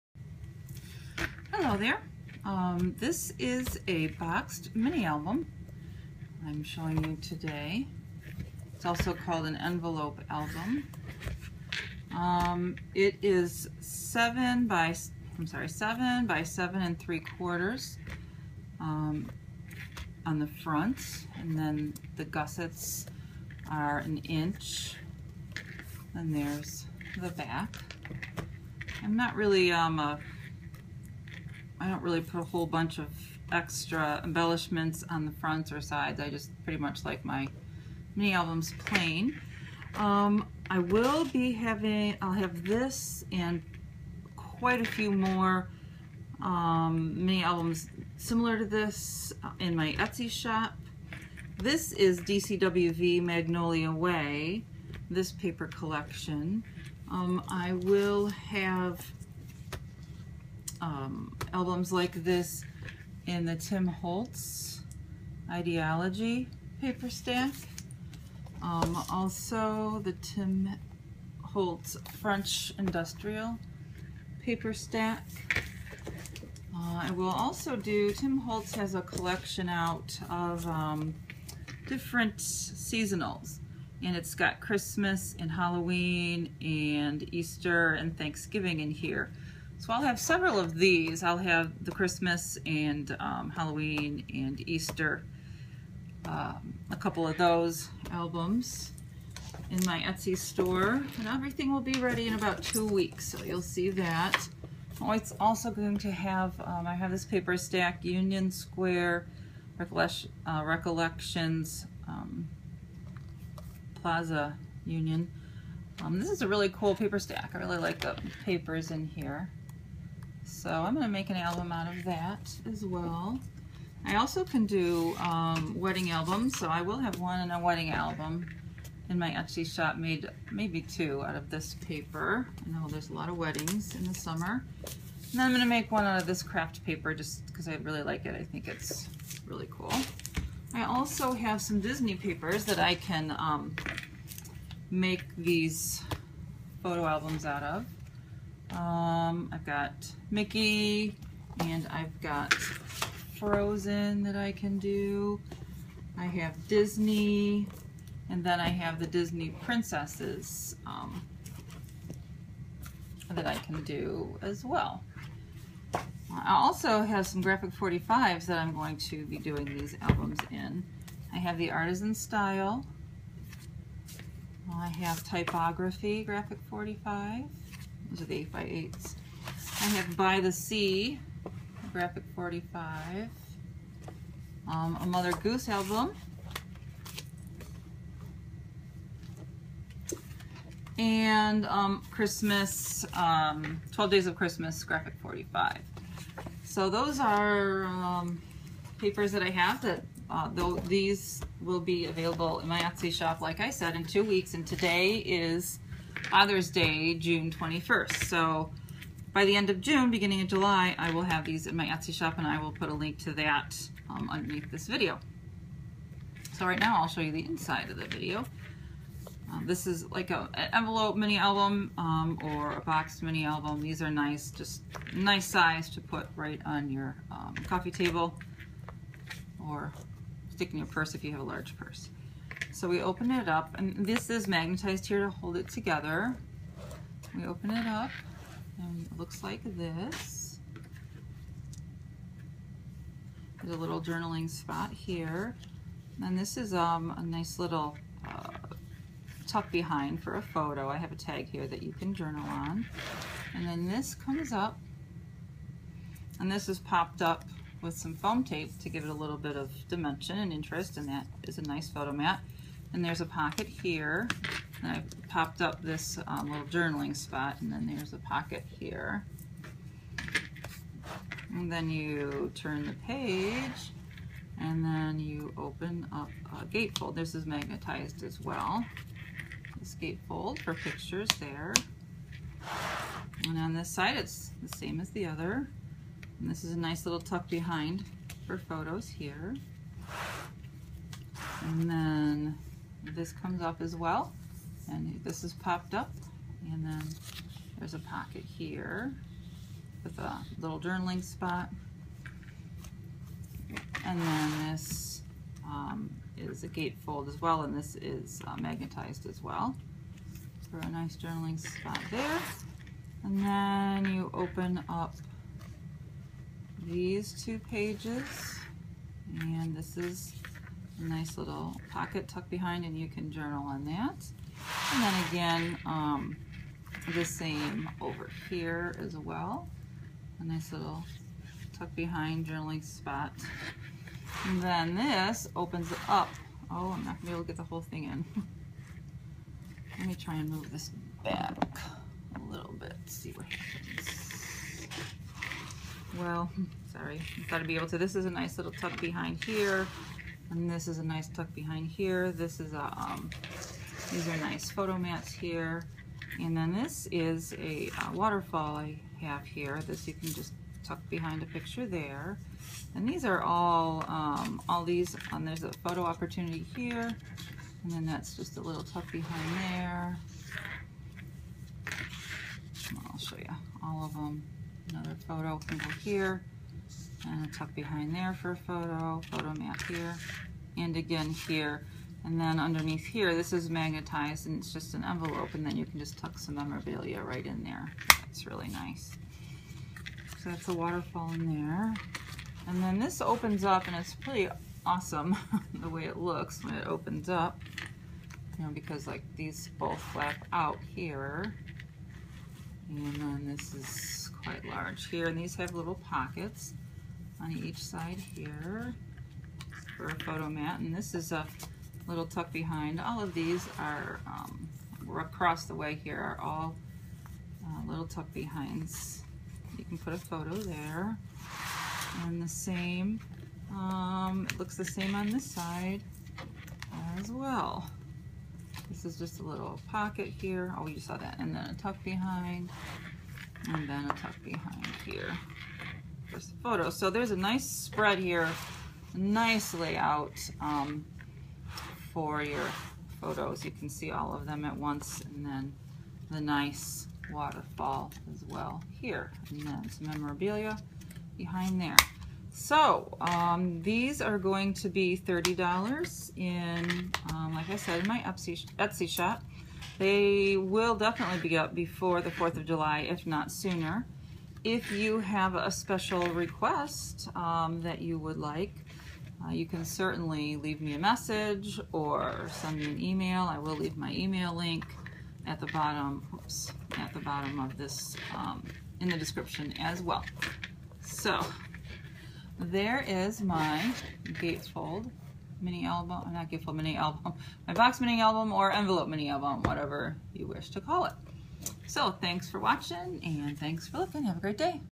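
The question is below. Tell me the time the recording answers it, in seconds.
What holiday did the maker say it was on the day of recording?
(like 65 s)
206 s.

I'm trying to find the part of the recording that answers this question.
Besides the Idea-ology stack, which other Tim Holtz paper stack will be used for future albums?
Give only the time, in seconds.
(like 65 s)
72 s.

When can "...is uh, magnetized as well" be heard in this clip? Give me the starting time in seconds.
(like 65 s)
307 s.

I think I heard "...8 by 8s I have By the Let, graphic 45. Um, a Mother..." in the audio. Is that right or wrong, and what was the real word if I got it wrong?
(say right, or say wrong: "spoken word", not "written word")
wrong: "Sea", not "Let".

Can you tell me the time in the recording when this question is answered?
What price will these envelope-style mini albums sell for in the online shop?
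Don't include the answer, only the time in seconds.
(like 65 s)
455 s.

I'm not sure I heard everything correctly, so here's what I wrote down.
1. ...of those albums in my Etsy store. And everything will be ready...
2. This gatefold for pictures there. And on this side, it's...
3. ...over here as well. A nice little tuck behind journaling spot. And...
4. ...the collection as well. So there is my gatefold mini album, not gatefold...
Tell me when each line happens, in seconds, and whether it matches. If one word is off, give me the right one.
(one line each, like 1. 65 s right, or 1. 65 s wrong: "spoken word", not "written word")
1. 97 s right
2. 279 s right
3. 327 s right
4. 479 s wrong: "description", not "collection".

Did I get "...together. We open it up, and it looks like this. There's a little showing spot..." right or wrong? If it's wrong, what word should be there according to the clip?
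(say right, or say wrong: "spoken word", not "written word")
wrong: "journaling", not "showing".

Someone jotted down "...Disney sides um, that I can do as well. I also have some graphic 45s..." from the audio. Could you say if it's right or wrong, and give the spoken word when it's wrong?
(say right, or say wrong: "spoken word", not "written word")
wrong: "princesses", not "sides".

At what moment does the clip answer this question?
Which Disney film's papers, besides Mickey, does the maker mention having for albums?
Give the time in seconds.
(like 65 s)
153 s.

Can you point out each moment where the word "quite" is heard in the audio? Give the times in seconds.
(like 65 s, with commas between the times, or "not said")
44 s, 404 s.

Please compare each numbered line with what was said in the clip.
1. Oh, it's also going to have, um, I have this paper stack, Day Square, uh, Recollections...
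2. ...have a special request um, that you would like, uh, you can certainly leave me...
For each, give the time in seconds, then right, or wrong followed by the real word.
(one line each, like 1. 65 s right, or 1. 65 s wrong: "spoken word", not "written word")
1. 105 s wrong: "Union", not "Day"
2. 465 s right.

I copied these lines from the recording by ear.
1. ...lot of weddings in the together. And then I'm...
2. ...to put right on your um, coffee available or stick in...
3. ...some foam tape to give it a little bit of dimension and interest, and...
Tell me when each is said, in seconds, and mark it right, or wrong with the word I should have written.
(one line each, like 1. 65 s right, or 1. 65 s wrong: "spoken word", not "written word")
1. 133 s wrong: "summer", not "together"
2. 225 s wrong: "table", not "available"
3. 257 s right.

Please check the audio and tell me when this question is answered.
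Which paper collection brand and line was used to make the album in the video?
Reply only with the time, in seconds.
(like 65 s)
52 s.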